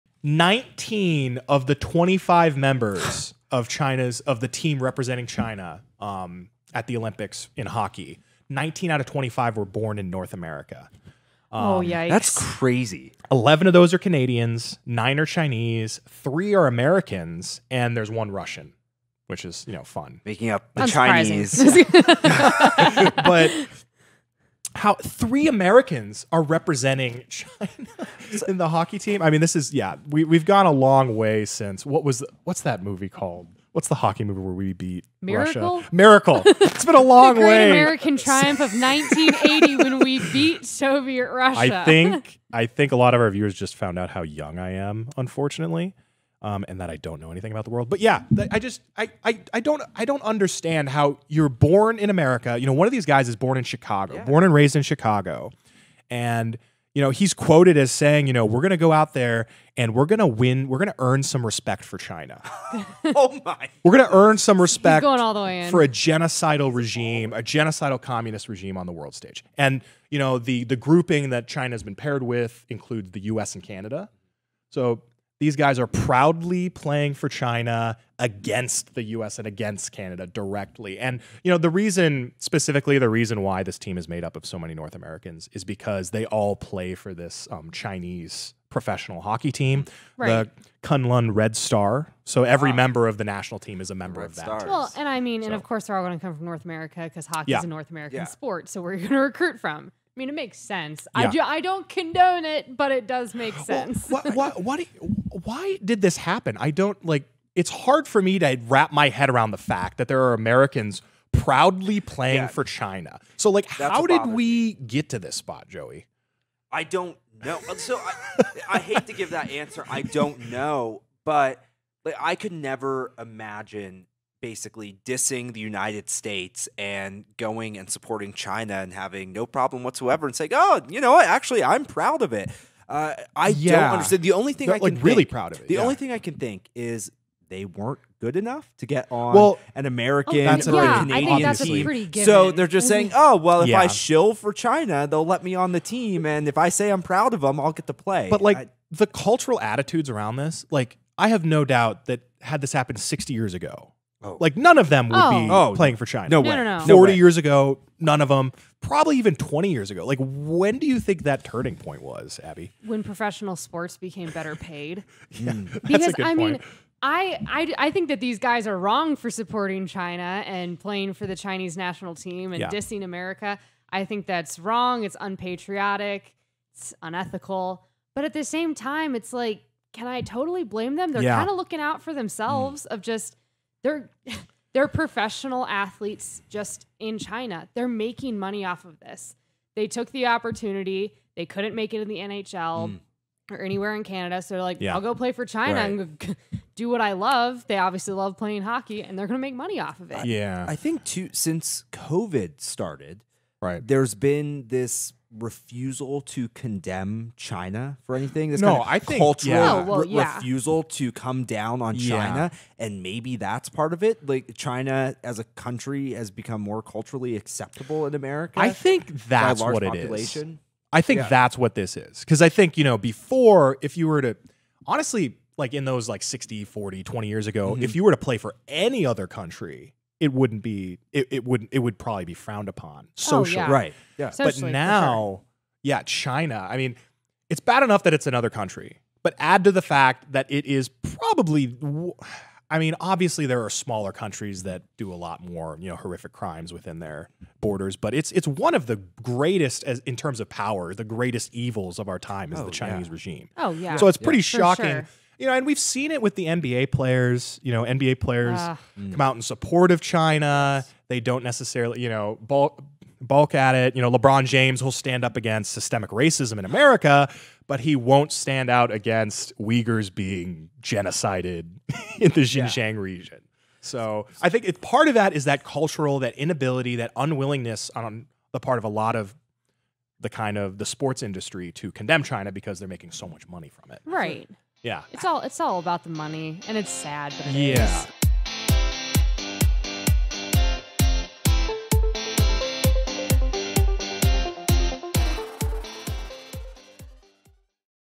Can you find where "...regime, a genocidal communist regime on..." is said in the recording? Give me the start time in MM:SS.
01:06.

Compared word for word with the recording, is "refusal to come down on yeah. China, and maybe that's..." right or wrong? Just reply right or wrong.
right.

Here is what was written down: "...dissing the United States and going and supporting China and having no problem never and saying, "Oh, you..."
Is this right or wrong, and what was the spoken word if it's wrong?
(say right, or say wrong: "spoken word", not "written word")
wrong: "whatsoever", not "never".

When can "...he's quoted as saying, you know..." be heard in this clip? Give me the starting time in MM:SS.
00:57.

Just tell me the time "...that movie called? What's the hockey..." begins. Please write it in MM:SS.
00:32.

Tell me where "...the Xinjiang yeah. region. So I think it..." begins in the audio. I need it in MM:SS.
04:32.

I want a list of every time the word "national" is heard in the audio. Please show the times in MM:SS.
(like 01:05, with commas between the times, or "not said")
01:33, 02:51.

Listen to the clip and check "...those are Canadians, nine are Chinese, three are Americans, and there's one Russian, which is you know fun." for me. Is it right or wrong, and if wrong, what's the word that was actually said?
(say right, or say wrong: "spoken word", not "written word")
right.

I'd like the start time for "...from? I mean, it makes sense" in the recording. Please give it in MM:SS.
01:39.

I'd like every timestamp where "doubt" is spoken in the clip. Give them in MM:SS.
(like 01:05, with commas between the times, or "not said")
02:31.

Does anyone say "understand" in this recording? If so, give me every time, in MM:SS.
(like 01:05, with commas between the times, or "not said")
00:50, 02:13.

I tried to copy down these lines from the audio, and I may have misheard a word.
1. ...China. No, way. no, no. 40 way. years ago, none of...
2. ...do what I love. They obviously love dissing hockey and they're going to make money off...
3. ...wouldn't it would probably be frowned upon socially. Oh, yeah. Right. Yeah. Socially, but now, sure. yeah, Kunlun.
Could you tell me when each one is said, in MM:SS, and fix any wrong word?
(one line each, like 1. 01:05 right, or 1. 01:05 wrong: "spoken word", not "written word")
1. 02:36 right
2. 03:16 wrong: "playing", not "dissing"
3. 03:51 wrong: "China", not "Kunlun".